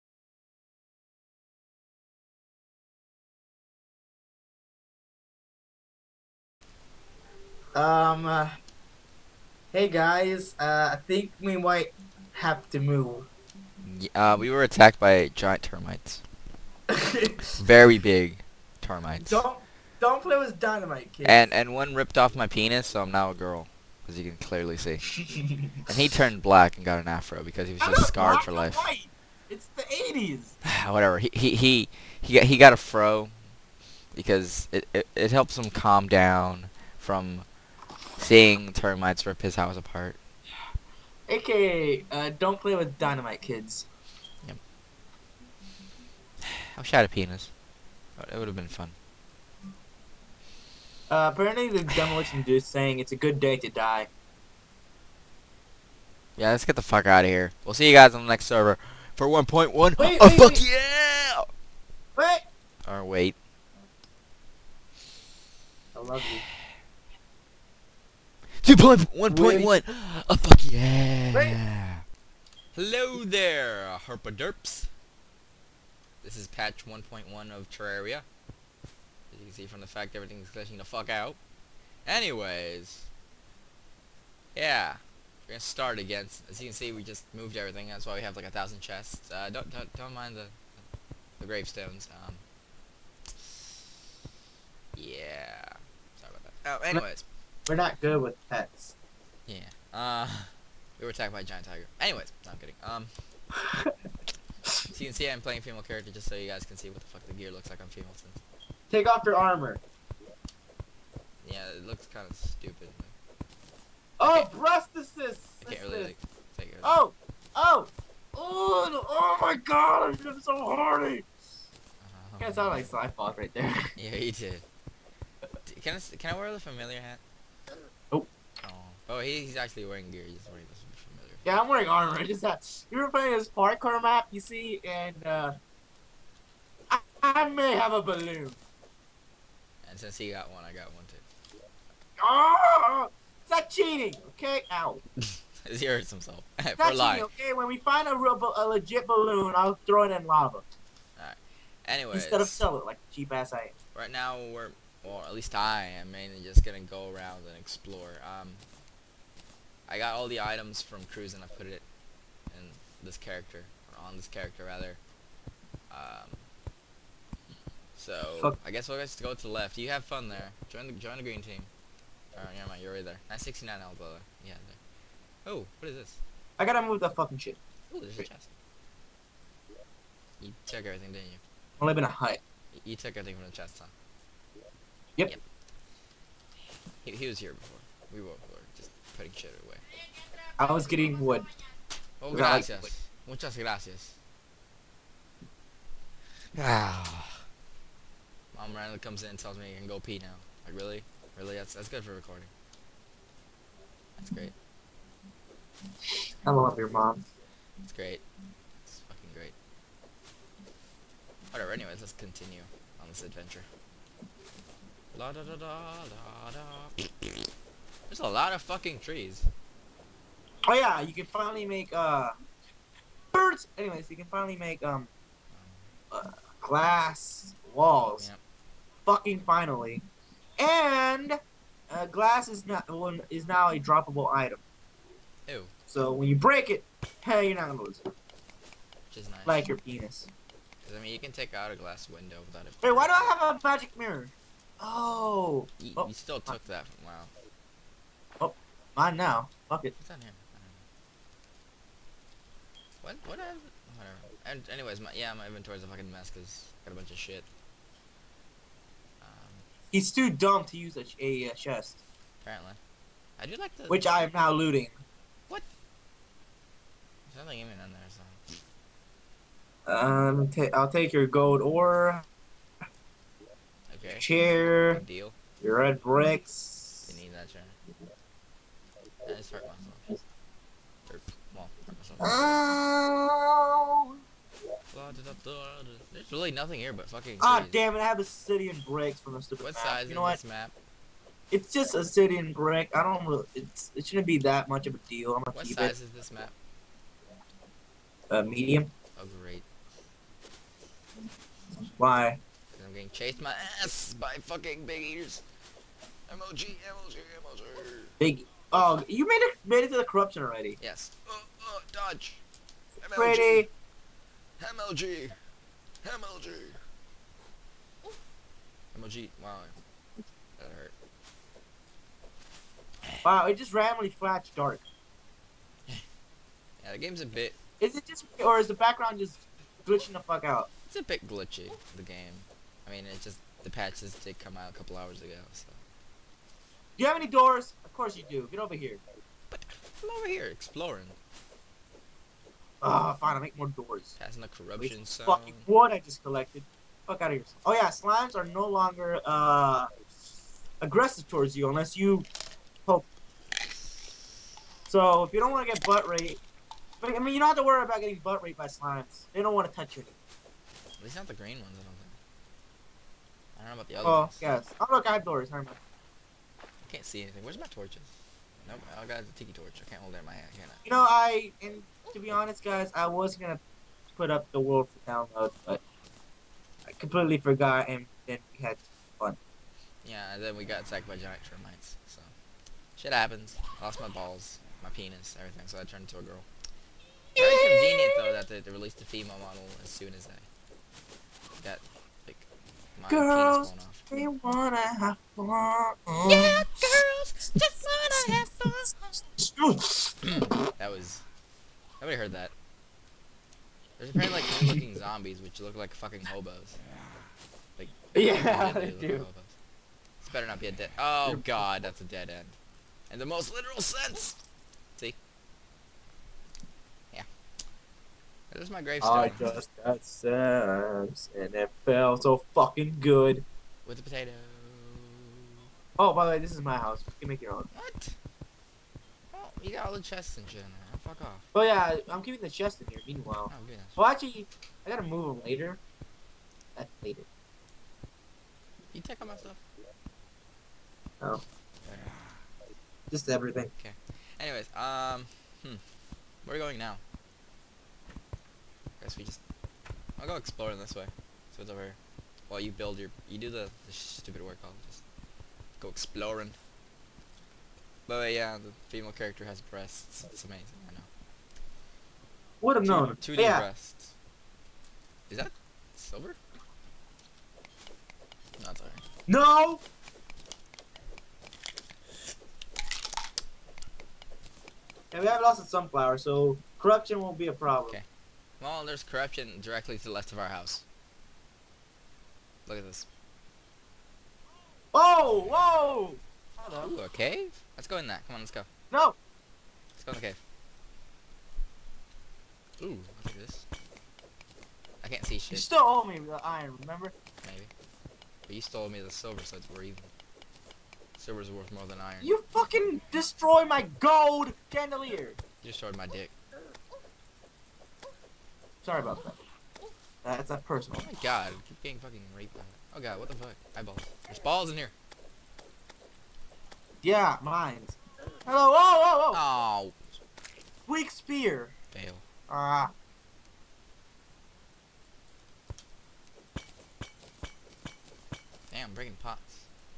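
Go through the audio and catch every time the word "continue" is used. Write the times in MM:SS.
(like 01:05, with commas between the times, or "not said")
03:32.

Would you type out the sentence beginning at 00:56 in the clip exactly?
Yeah, let's get the fuck out of here.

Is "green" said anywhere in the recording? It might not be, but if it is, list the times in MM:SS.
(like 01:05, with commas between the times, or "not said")
02:51, 06:01.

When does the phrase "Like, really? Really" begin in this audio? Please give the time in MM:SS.
03:20.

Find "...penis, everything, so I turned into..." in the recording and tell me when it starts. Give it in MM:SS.
06:24.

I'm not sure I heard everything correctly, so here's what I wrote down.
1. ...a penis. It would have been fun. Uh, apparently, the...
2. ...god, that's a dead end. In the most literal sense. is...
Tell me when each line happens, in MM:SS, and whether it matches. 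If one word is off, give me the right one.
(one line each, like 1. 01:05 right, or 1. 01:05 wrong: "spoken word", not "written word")
1. 00:47 right
2. 06:51 right.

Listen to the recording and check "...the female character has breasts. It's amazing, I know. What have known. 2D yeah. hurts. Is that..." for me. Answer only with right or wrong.
wrong.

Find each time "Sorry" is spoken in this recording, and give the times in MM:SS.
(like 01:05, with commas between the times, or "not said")
01:36, 08:28.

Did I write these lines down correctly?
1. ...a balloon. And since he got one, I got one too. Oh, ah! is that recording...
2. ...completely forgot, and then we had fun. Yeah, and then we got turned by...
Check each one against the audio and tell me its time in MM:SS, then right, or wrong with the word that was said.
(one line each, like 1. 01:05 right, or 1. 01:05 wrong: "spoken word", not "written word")
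1. 02:17 wrong: "cheating", not "recording"
2. 06:16 wrong: "attacked", not "turned".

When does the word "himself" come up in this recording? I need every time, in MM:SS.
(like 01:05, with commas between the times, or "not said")
02:26.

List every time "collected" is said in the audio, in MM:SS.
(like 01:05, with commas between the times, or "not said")
05:46.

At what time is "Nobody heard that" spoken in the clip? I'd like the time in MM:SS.
06:41.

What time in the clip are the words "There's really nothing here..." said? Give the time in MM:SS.
04:46.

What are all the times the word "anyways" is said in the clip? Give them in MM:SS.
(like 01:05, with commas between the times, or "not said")
01:22, 01:36, 01:41, 02:31, 03:31, 03:43, 04:14, 07:24.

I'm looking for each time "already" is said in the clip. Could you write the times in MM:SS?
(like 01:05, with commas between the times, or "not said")
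05:10.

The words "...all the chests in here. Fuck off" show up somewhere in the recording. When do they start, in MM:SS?
07:09.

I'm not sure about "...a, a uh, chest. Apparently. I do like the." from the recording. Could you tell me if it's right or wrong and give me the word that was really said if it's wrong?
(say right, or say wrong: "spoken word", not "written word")
right.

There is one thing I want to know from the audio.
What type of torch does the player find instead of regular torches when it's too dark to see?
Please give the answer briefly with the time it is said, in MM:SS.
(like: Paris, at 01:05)
Tiki torch, at 06:09.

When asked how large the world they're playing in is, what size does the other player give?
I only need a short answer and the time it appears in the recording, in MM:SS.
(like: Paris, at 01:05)
Medium, at 04:58.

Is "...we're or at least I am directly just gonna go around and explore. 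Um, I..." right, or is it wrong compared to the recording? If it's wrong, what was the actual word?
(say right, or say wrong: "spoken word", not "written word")
wrong: "mainly", not "directly".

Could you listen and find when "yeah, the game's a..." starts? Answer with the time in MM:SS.
05:25.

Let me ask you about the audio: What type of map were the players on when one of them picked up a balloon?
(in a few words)
Parkour map.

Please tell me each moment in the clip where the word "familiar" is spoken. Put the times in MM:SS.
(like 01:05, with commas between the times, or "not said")
02:06, 02:11.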